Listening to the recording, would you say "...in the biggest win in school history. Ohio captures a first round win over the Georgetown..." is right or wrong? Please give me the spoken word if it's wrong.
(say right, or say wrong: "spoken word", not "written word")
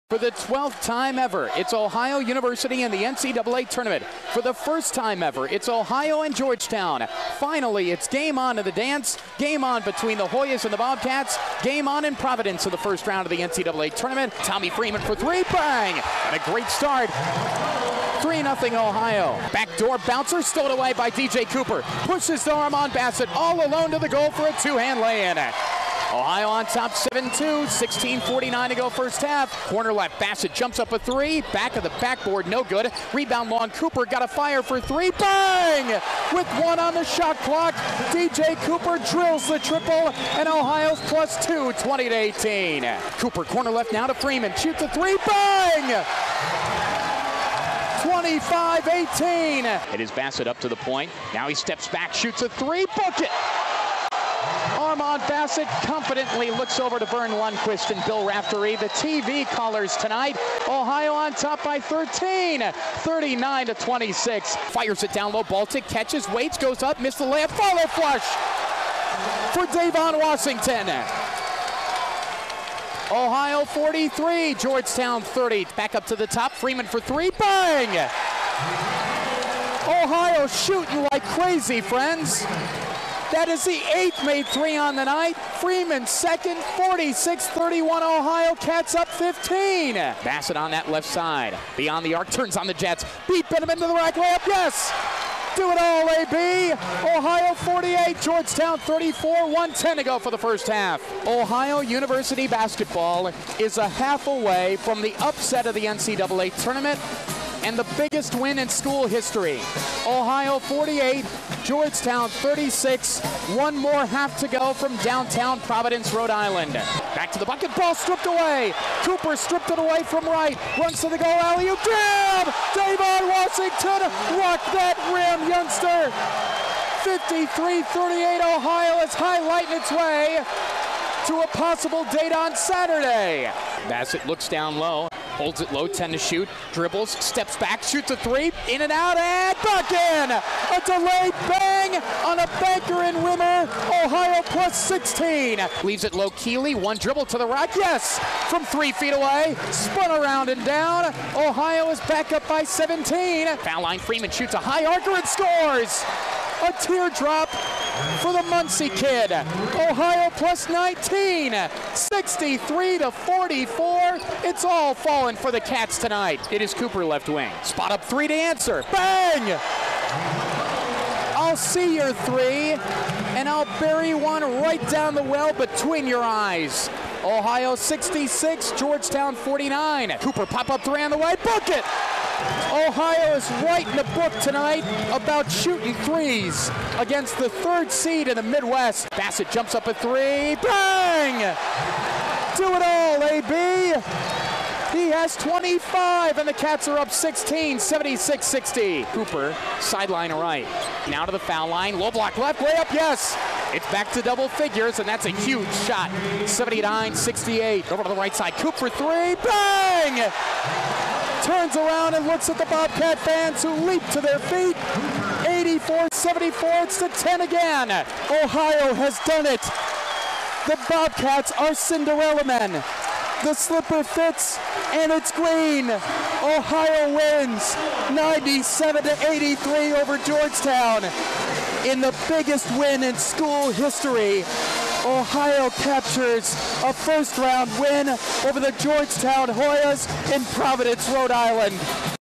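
right.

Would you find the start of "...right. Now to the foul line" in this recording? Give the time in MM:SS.
03:20.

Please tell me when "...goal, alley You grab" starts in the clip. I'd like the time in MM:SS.
02:01.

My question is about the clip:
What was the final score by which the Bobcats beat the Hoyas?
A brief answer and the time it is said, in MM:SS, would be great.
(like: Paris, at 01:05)
97 to 83, at 03:48.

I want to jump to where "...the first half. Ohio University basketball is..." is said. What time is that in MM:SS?
01:40.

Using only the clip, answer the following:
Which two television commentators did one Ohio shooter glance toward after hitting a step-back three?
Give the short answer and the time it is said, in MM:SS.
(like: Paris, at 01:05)
Verne Lundquist and Bill Raftery, at 00:57.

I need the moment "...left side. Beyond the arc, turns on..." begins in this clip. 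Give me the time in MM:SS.
01:30.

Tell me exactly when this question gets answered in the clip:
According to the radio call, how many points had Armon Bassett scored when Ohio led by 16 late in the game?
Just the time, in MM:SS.
03:15.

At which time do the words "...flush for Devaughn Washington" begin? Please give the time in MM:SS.
01:07.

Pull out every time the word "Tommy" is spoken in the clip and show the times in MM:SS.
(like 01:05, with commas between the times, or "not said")
00:14.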